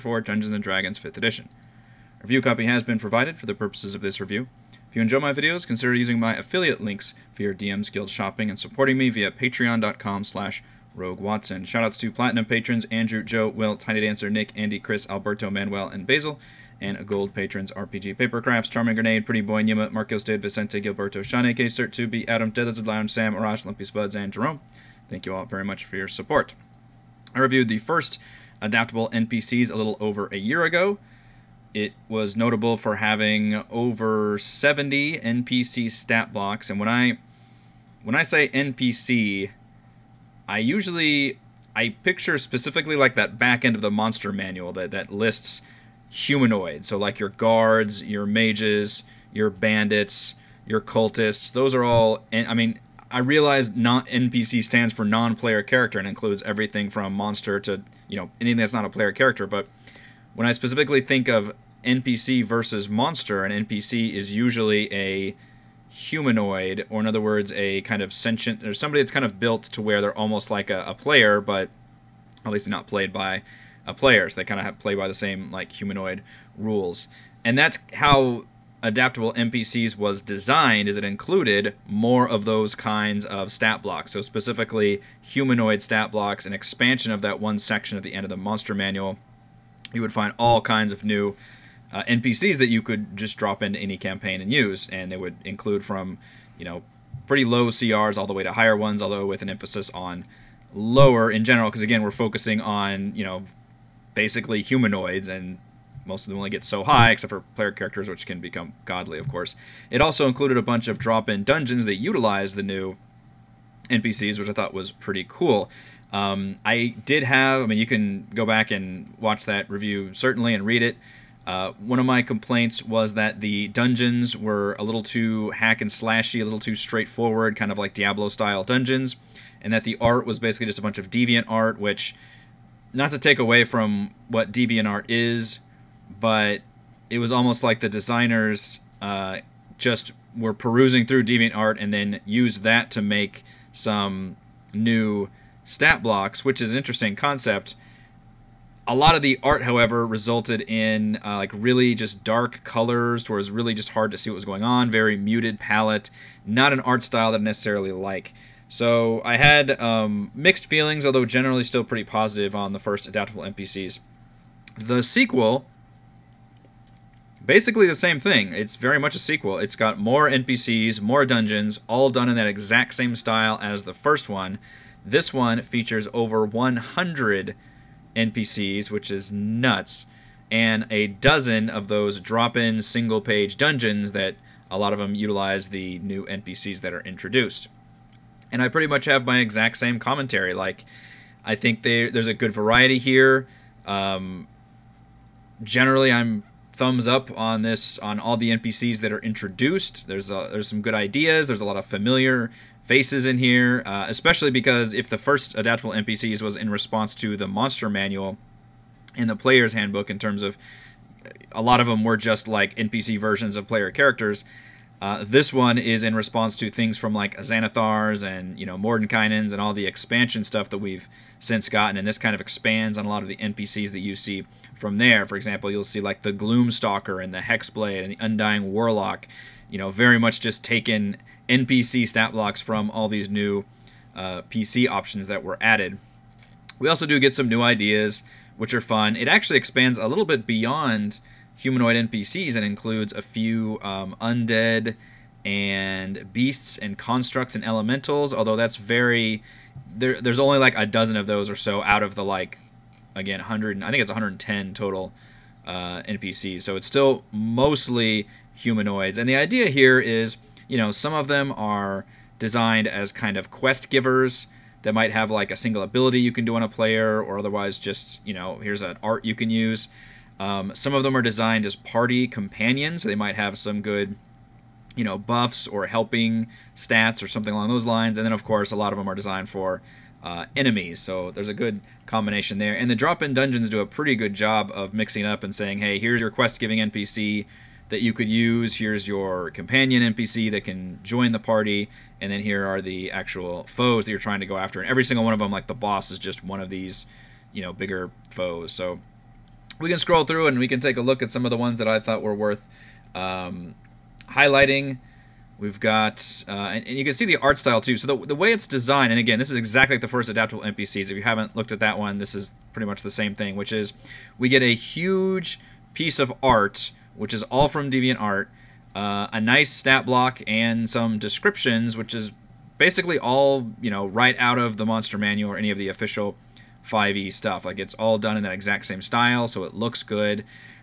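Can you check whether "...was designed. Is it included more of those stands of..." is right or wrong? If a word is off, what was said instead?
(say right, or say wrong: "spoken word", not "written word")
wrong: "kinds", not "stands".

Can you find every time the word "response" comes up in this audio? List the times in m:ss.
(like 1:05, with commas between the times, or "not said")
3:26, 3:36.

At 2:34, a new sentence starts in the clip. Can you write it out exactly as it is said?
Very muted palette, not an art style that I necessarily like.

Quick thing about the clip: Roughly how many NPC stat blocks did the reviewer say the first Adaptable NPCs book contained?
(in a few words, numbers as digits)
over 70.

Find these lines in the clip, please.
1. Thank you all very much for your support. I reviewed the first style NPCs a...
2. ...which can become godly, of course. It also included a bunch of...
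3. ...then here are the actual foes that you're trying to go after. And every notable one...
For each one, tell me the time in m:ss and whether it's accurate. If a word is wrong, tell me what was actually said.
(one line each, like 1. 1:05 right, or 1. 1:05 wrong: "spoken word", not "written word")
1. 0:25 wrong: "adaptable", not "style"
2. 1:48 right
3. 4:52 wrong: "single", not "notable".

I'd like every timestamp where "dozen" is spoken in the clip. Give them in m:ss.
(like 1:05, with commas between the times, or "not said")
3:01, 4:10.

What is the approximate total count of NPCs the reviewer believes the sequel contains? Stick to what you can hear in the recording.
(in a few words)
110.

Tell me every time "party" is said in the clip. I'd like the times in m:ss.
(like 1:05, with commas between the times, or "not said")
4:31, 4:51.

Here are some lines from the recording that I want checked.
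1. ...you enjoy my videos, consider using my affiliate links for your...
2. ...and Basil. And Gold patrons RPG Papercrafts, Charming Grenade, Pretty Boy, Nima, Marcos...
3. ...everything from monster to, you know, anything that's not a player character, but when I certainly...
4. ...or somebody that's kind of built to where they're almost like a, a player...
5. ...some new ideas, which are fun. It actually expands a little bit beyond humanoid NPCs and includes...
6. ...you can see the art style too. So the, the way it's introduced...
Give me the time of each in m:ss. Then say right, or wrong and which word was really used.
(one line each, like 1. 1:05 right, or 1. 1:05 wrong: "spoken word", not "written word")
1. 0:04 right
2. 0:15 right
3. 0:56 wrong: "specifically", not "certainly"
4. 1:08 right
5. 3:57 right
6. 5:06 wrong: "designed", not "introduced".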